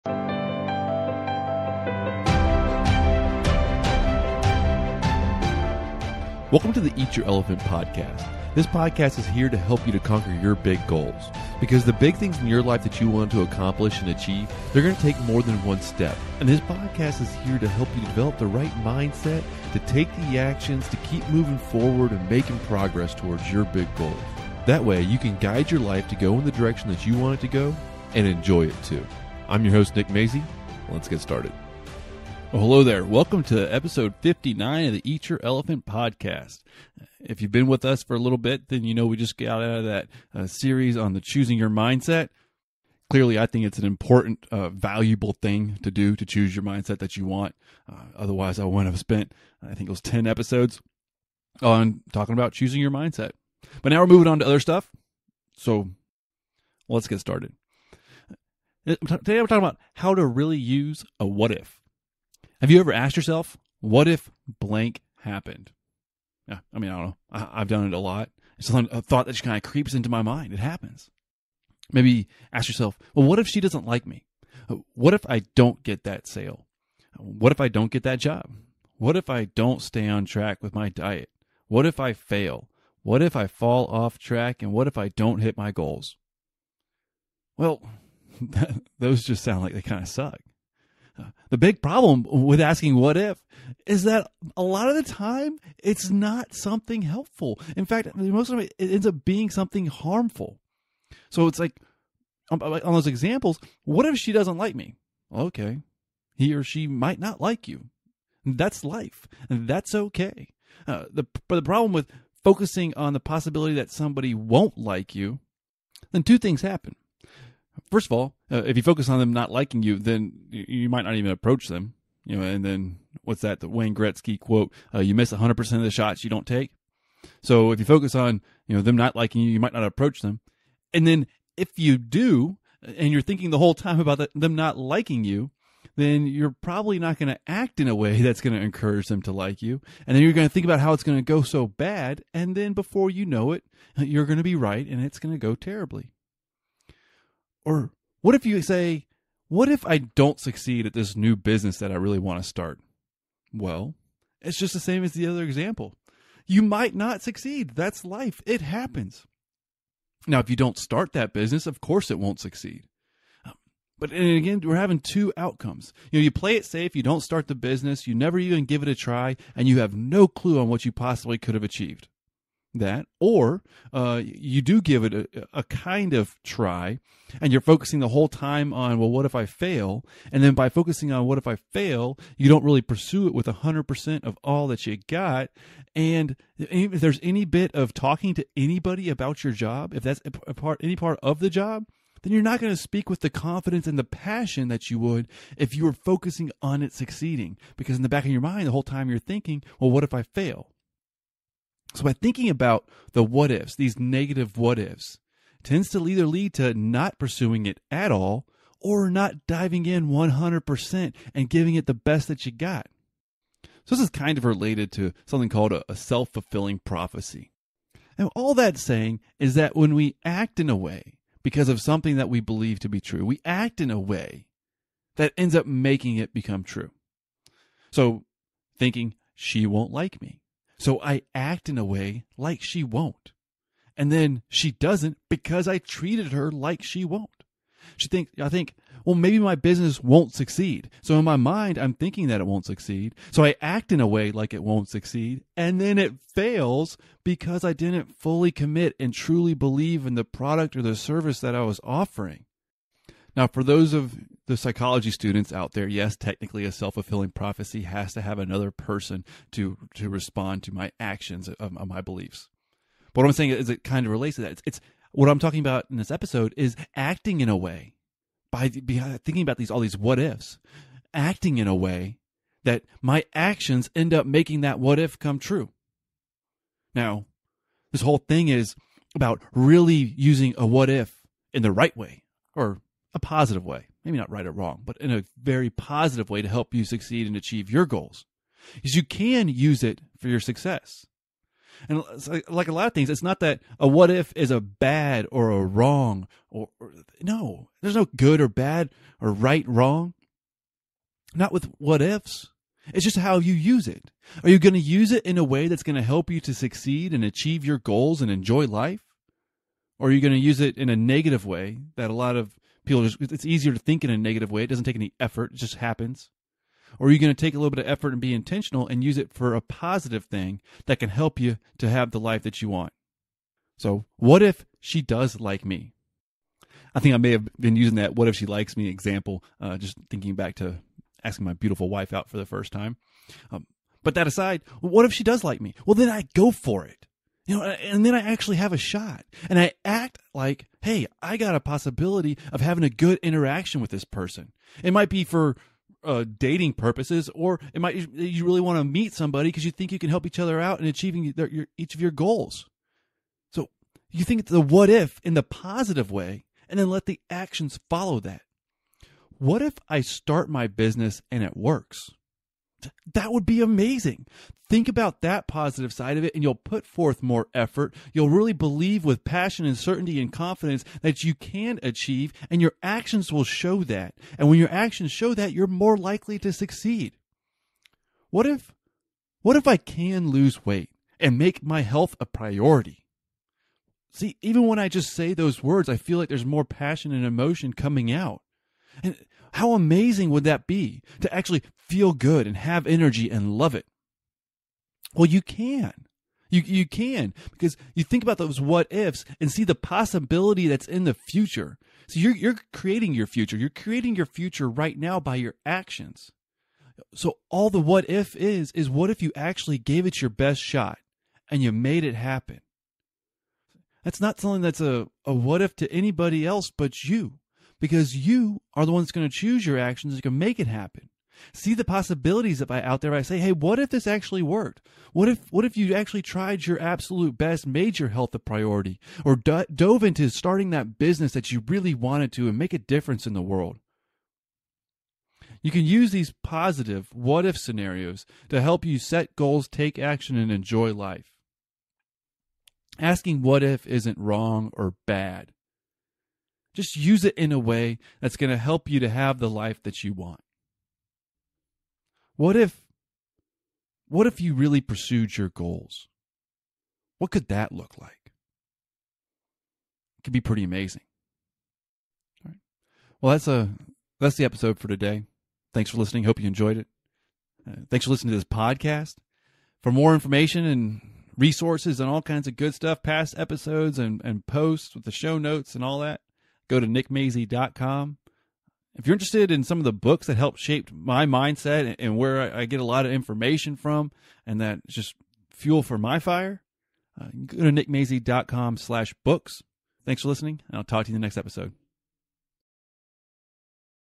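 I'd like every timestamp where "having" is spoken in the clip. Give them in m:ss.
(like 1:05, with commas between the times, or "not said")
2:44, 5:42.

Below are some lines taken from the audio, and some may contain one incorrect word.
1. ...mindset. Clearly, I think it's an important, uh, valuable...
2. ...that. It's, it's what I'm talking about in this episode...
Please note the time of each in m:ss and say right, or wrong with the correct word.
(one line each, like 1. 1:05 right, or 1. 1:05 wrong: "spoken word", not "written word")
1. 0:41 right
2. 4:24 right.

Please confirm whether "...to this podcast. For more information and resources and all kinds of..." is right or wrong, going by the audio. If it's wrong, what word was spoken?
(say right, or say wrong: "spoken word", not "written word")
right.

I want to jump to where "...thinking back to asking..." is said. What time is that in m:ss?
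5:30.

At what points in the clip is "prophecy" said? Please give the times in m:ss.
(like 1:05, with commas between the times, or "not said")
3:36, 4:17.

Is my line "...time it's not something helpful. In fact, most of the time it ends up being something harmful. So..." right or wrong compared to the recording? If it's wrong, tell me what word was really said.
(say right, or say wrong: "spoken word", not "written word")
right.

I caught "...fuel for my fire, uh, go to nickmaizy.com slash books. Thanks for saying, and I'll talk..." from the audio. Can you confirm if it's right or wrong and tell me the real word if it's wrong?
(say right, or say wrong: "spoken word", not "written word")
wrong: "listening", not "saying".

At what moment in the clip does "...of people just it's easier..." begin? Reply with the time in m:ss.
5:12.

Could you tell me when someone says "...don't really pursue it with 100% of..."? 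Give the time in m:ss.
3:02.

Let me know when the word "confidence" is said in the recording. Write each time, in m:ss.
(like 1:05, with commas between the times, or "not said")
3:13, 6:10.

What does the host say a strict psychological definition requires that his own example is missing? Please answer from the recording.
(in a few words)
another person.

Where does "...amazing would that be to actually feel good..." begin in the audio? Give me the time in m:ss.
6:29.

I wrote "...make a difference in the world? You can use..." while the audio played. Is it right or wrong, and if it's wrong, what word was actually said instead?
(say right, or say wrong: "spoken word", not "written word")
right.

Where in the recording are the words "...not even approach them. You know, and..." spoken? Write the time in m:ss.
2:01.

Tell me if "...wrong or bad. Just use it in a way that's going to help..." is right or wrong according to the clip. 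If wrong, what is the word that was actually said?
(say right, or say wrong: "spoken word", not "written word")
right.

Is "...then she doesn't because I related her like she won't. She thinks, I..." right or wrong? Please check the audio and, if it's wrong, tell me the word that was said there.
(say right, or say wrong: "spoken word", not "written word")
wrong: "treated", not "related".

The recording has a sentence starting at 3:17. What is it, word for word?
Because in the back of your mind, the whole time you're thinking, well, what if I fail?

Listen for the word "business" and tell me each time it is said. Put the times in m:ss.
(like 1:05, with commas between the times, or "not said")
2:31, 2:41, 2:47, 3:59, 6:00, 7:10.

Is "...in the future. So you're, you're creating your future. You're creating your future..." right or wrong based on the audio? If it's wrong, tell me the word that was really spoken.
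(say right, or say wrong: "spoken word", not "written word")
right.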